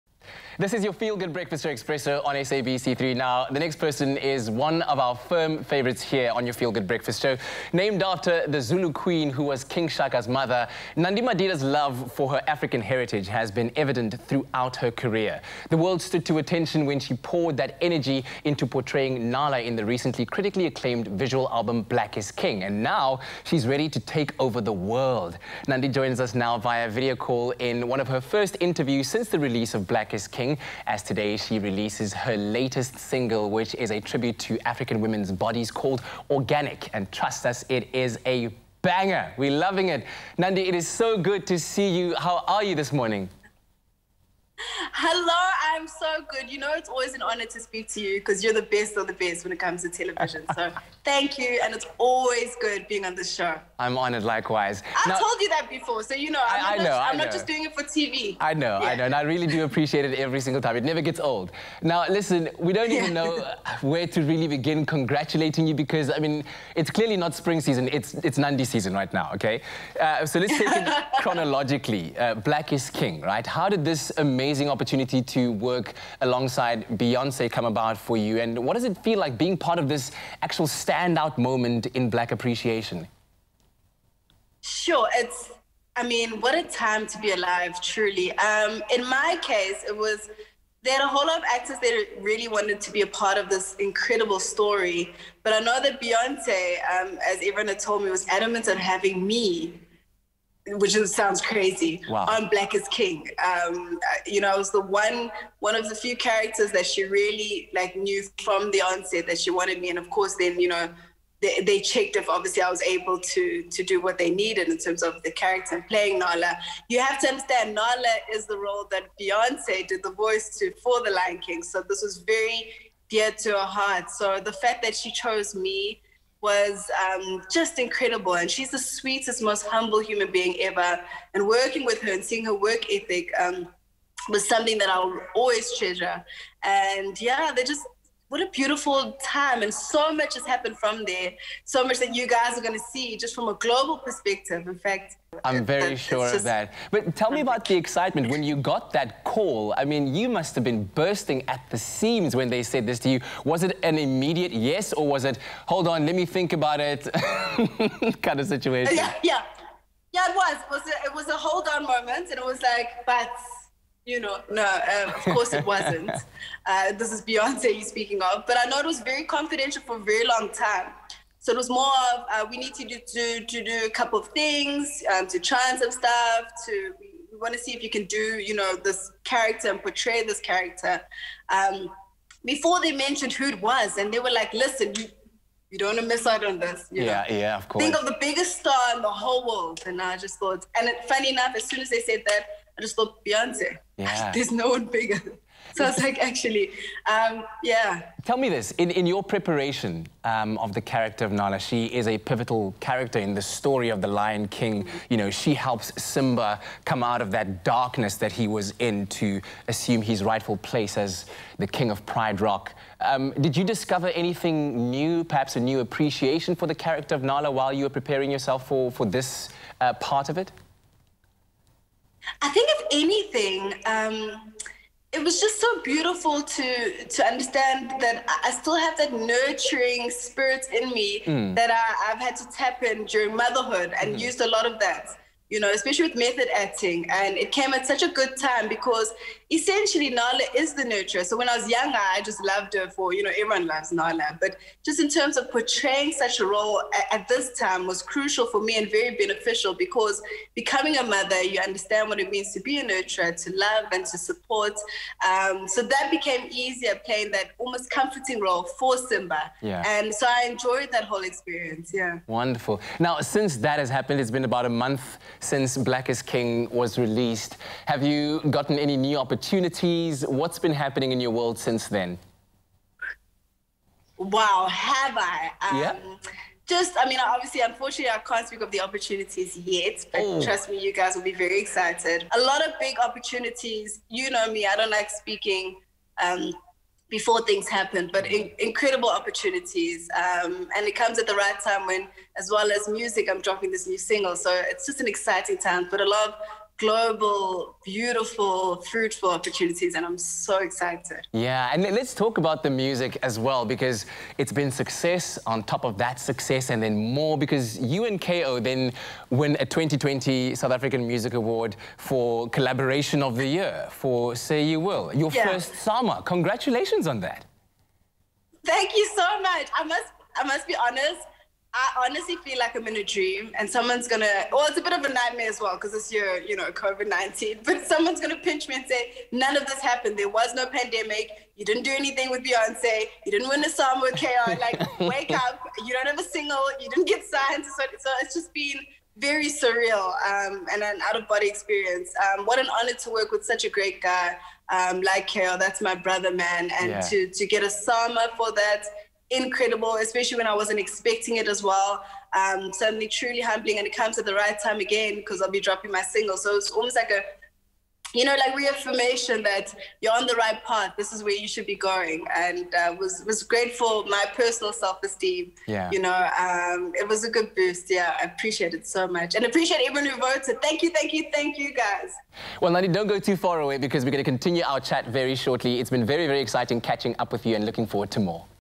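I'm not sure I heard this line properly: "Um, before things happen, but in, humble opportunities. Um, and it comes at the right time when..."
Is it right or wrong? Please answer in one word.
wrong.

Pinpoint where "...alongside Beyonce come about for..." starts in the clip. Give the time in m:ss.
1:16.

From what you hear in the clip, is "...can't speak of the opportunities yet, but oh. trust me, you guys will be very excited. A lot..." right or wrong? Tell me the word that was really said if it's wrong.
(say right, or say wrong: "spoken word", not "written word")
right.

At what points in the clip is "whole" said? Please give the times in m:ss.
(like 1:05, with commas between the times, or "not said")
1:31, 3:09, 4:21.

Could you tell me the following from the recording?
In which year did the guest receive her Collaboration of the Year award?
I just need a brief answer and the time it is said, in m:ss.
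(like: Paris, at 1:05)
2020, at 5:09.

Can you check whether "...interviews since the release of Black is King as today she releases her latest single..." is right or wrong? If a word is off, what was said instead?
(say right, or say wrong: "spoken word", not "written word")
right.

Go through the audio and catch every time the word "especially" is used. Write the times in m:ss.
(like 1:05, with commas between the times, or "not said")
3:55, 5:49.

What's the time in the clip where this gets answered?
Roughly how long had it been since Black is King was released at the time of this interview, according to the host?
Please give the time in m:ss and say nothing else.
4:24.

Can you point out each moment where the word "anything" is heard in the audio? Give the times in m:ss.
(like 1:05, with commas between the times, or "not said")
3:34, 3:42, 5:31.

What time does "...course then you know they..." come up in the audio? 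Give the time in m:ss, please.
1:50.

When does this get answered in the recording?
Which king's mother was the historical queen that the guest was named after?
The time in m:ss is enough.
0:09.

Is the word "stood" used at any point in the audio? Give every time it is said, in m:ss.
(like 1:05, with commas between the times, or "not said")
0:16.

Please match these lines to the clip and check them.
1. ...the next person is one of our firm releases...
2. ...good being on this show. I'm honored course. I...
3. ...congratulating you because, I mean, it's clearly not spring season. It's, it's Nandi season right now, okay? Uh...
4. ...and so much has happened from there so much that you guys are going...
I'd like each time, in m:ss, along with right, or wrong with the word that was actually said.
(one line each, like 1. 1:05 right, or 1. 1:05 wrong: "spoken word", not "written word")
1. 0:03 wrong: "favorites", not "releases"
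2. 0:52 wrong: "likewise", not "course"
3. 1:04 right
4. 2:19 right.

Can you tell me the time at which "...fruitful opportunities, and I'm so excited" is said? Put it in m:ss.
4:58.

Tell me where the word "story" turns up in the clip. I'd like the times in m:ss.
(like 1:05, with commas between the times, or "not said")
1:34, 3:23.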